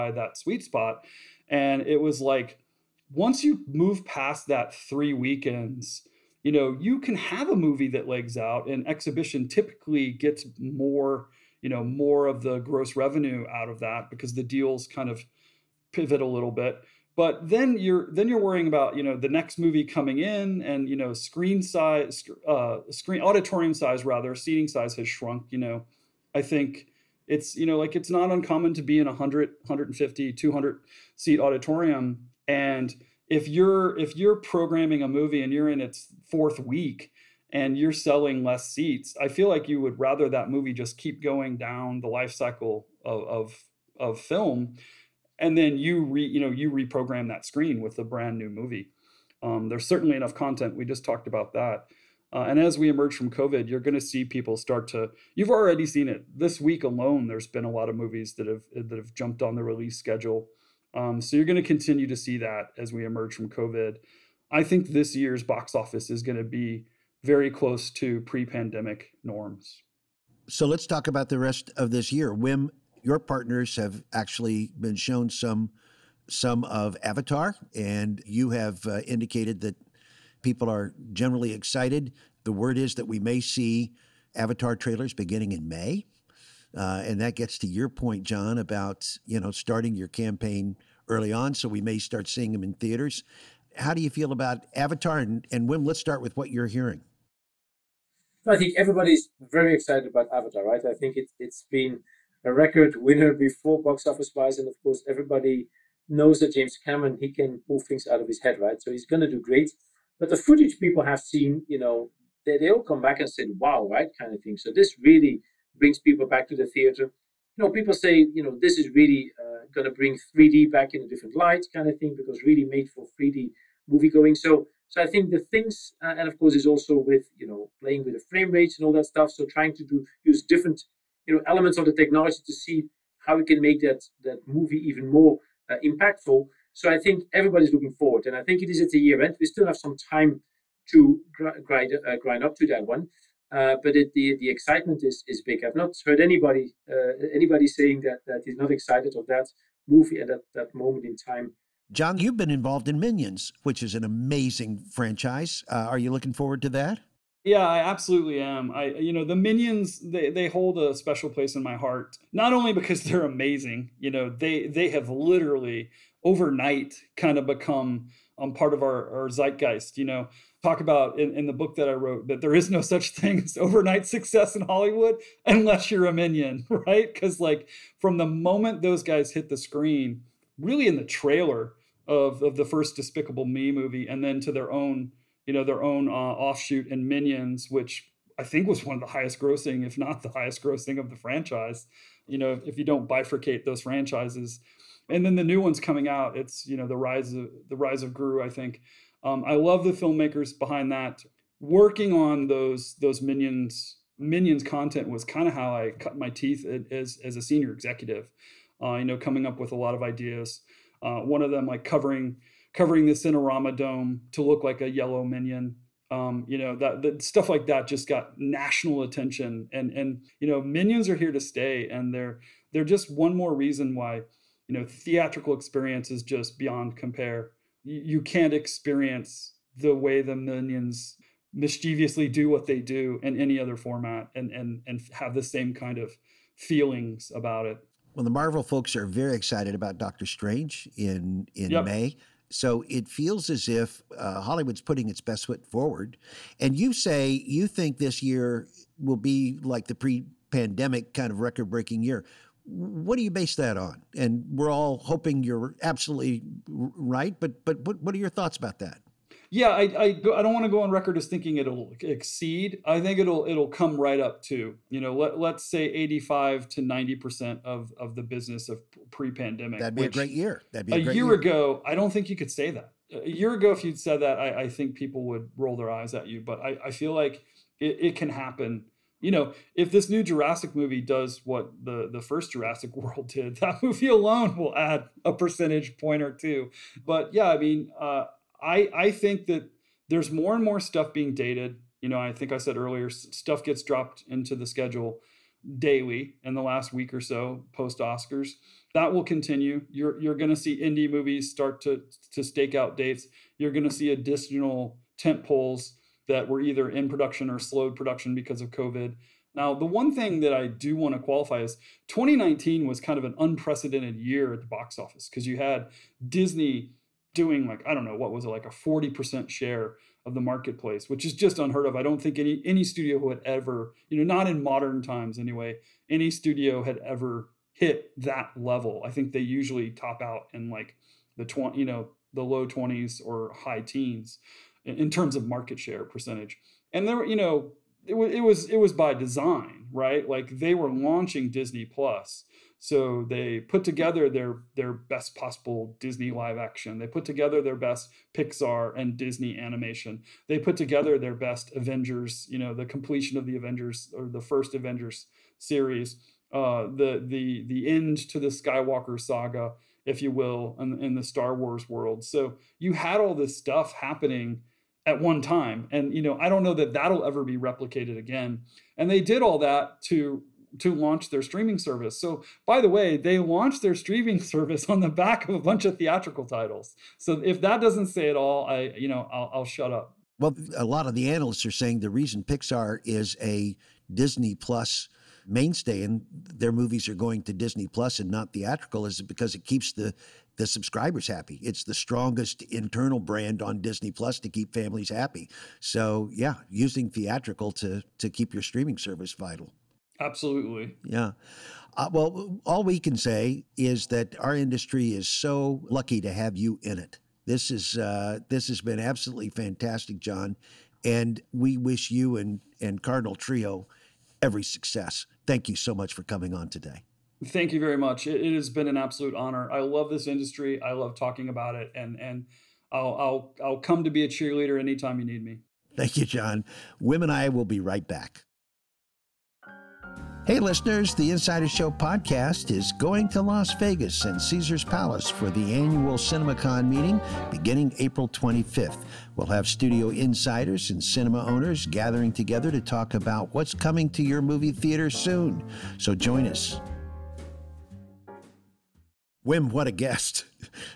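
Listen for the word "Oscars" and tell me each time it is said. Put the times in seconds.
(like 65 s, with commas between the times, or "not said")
297 s.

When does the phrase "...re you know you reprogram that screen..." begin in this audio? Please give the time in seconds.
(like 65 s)
46 s.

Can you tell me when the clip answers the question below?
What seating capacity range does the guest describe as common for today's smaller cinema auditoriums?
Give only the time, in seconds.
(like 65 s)
29 s.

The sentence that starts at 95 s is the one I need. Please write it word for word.
Let's start with what you're hearing.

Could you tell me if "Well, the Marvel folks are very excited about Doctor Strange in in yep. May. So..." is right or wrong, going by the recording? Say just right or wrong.
right.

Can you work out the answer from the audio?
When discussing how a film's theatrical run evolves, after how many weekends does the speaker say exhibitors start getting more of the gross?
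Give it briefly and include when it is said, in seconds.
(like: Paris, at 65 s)
3 weekends, at 4 s.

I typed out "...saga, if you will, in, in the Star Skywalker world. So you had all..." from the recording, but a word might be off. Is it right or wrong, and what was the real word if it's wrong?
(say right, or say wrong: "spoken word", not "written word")
wrong: "Wars", not "Skywalker".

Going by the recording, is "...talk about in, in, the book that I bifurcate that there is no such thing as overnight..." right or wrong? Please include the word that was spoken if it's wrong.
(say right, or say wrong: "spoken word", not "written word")
wrong: "wrote", not "bifurcate".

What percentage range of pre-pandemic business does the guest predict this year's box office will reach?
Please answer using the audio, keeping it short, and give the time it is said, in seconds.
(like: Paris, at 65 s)
85 to 90 percent, at 265 s.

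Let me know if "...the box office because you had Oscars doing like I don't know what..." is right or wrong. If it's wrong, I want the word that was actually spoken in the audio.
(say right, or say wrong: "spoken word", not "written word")
wrong: "Disney", not "Oscars".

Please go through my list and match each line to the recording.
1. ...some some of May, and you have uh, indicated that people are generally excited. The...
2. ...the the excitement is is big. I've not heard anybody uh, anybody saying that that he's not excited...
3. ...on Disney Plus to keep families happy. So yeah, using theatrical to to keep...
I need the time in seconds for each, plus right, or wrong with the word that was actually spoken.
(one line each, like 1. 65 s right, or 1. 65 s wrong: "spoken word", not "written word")
1. 75 s wrong: "Avatar", not "May"
2. 144 s right
3. 393 s right.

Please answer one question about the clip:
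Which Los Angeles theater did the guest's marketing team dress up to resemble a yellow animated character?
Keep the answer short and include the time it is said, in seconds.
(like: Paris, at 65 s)
Cinerama Dome, at 213 s.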